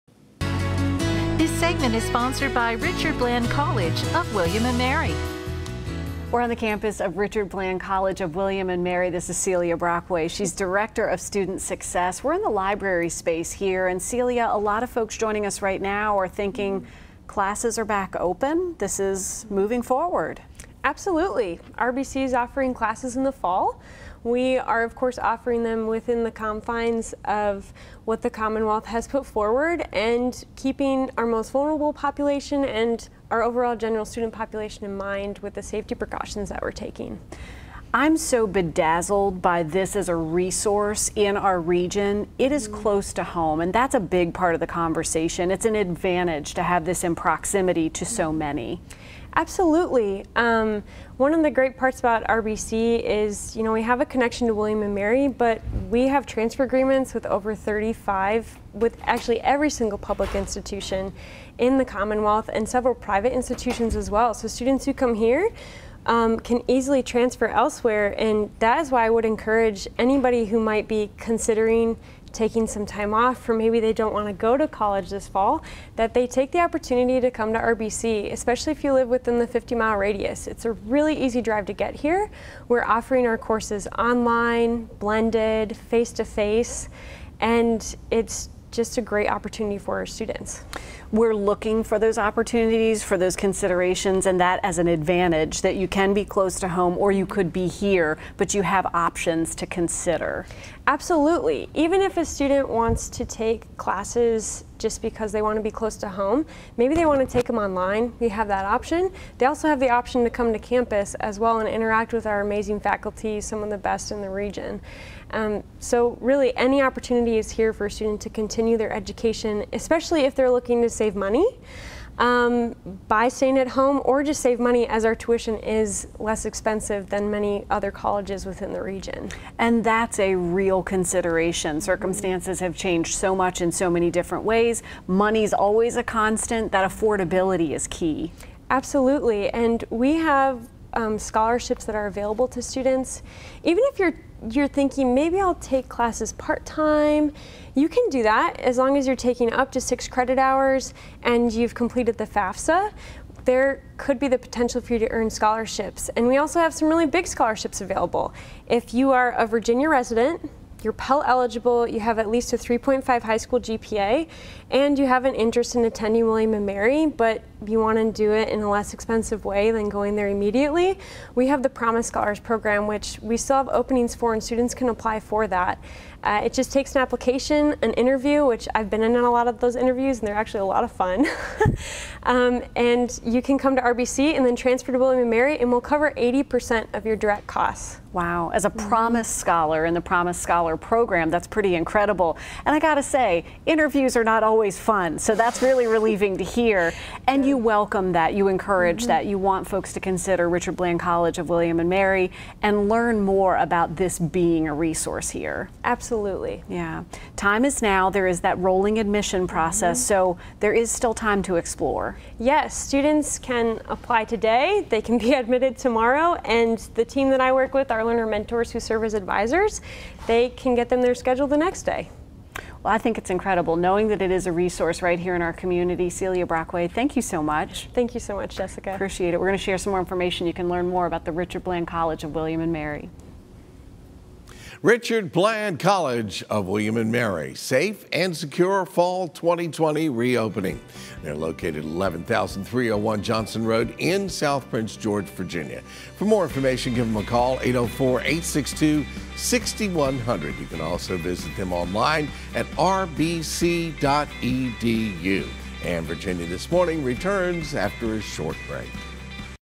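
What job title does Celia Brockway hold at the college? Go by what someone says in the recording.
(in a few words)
Director of Student Success.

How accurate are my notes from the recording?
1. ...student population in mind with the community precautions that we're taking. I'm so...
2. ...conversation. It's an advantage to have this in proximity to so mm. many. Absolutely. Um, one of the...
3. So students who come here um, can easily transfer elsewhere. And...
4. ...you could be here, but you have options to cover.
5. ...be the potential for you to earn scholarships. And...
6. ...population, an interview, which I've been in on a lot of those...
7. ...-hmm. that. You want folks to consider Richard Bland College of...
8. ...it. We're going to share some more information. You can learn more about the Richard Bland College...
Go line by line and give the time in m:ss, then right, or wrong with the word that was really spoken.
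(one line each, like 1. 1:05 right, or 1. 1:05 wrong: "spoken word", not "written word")
1. 0:34 wrong: "safety", not "community"
2. 0:44 right
3. 1:04 right
4. 1:37 wrong: "consider", not "cover"
5. 2:34 right
6. 2:57 wrong: "application", not "population"
7. 3:19 right
8. 3:49 right.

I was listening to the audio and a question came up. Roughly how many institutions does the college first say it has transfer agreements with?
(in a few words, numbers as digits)
over 35.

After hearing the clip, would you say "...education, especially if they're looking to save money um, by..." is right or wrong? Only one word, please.
right.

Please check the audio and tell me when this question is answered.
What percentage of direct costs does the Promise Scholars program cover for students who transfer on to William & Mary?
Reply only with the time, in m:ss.
3:06.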